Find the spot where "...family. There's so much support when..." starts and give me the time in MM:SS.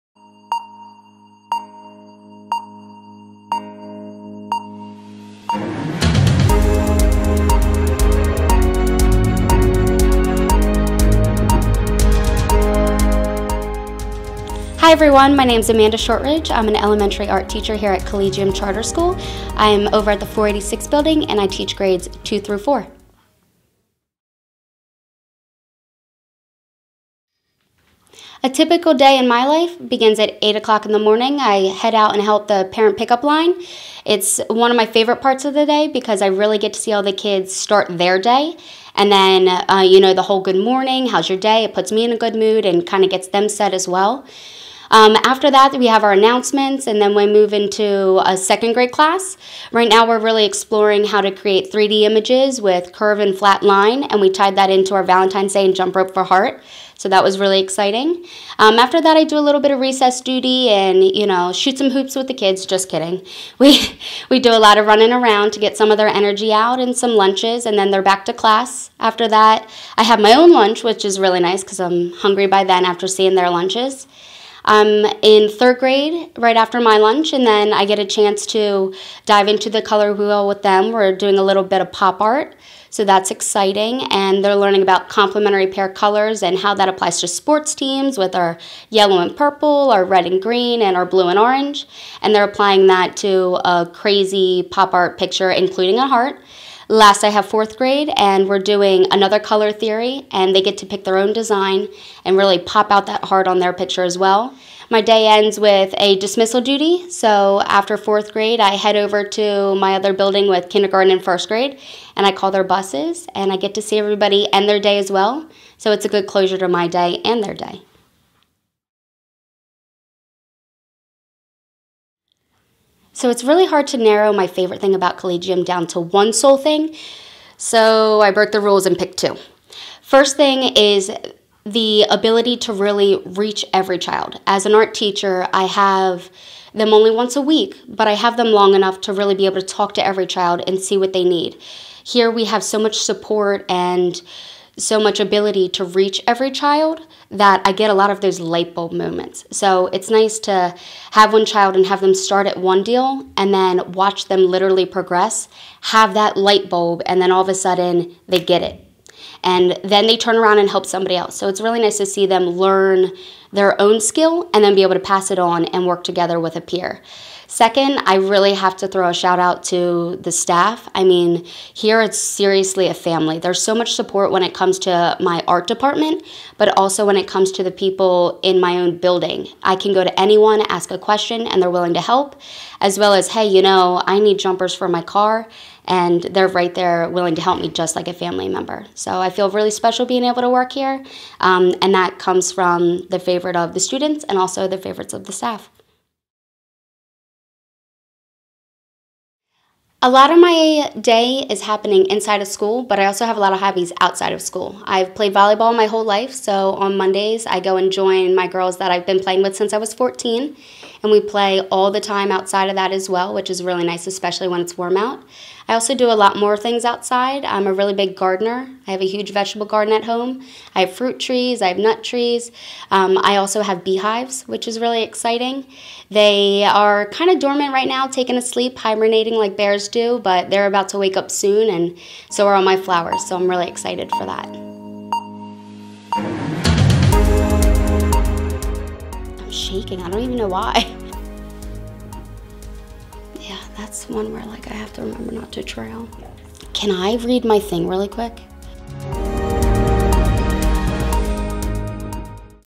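02:52.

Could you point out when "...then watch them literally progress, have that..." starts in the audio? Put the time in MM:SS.
02:33.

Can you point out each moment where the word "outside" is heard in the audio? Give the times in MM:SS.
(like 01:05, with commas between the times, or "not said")
03:24, 03:32, 03:36.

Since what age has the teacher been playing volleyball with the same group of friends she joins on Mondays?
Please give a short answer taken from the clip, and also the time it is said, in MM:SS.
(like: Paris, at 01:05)
14, at 03:29.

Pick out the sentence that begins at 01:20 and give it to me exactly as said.
We're doing a little bit of pop art, so that's exciting.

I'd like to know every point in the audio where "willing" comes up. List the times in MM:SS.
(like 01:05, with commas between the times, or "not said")
03:01, 03:07.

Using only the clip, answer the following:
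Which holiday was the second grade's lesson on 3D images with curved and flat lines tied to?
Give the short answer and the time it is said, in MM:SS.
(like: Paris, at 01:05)
Valentine's Day, at 00:55.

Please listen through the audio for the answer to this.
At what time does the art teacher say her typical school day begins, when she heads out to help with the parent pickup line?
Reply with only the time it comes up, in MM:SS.
00:30.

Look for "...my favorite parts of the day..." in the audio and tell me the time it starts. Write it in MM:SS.
00:34.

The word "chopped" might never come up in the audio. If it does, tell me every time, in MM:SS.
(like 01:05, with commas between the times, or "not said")
not said.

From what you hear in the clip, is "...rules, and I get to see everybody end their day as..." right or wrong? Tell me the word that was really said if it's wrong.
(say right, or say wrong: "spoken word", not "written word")
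wrong: "buses", not "rules".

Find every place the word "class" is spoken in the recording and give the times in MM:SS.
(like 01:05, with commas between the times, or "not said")
00:48, 01:08.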